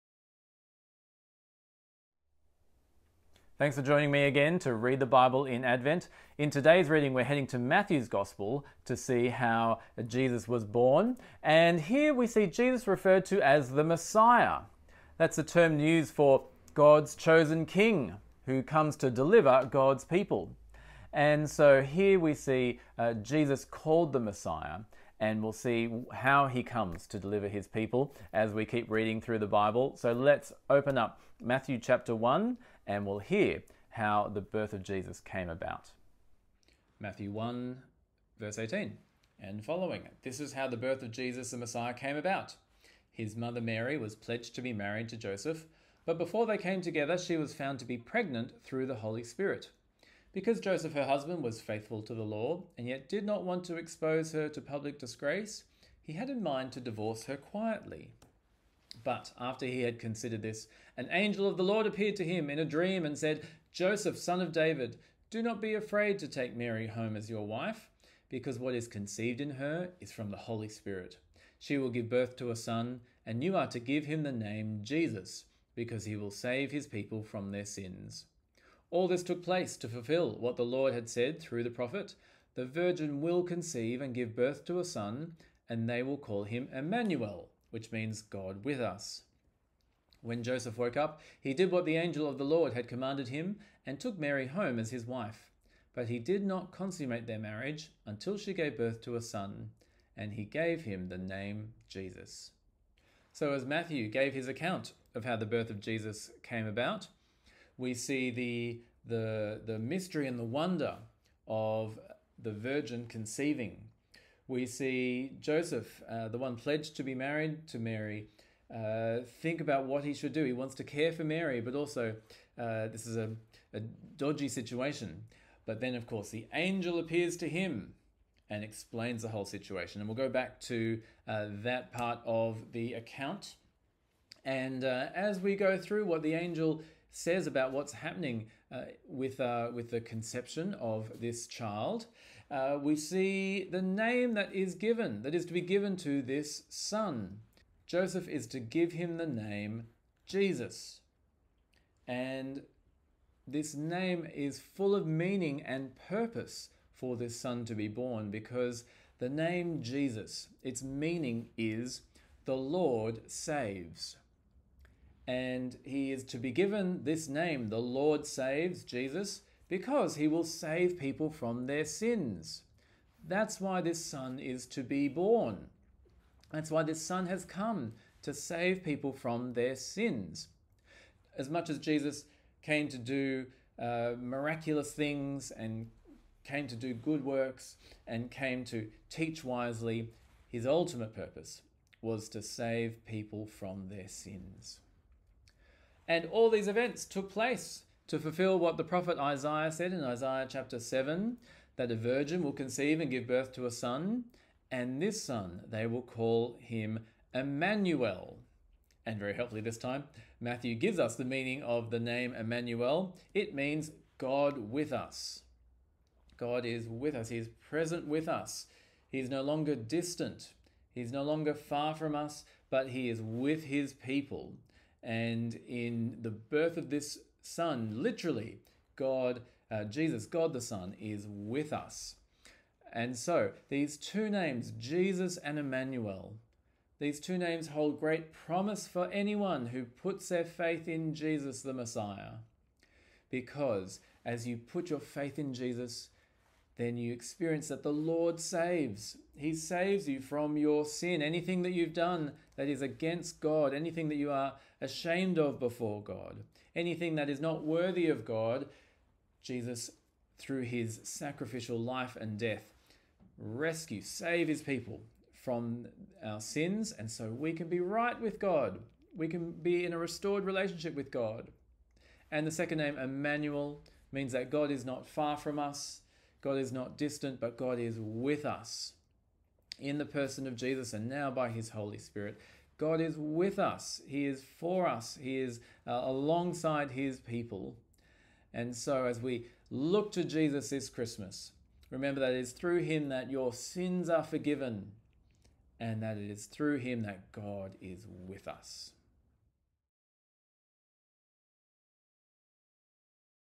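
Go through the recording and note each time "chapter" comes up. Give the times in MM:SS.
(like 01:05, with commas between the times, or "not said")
00:31, 03:20.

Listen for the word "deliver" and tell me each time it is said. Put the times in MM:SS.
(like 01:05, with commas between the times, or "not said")
00:19, 00:27.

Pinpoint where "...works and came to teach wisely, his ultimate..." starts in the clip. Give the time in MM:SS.
03:07.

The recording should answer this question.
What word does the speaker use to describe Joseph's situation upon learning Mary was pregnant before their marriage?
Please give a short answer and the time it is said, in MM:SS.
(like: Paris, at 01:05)
dodgy, at 02:03.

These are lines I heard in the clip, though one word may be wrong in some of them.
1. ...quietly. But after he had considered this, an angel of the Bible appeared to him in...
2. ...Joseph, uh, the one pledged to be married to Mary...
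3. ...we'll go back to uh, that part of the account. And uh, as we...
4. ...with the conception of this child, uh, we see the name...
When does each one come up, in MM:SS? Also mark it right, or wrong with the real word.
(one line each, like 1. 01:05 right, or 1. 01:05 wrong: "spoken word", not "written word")
1. 00:57 wrong: "Lord", not "Bible"
2. 01:55 right
3. 02:10 right
4. 02:19 right.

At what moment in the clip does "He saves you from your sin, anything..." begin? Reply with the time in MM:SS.
04:09.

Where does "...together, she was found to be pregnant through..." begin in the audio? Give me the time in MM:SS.
00:46.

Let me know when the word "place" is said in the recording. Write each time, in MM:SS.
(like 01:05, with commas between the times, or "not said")
01:19, 03:17.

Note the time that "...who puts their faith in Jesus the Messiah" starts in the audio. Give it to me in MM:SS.
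03:59.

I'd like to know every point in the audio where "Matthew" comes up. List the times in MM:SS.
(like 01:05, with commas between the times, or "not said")
00:07, 00:31, 00:36, 01:43, 03:30.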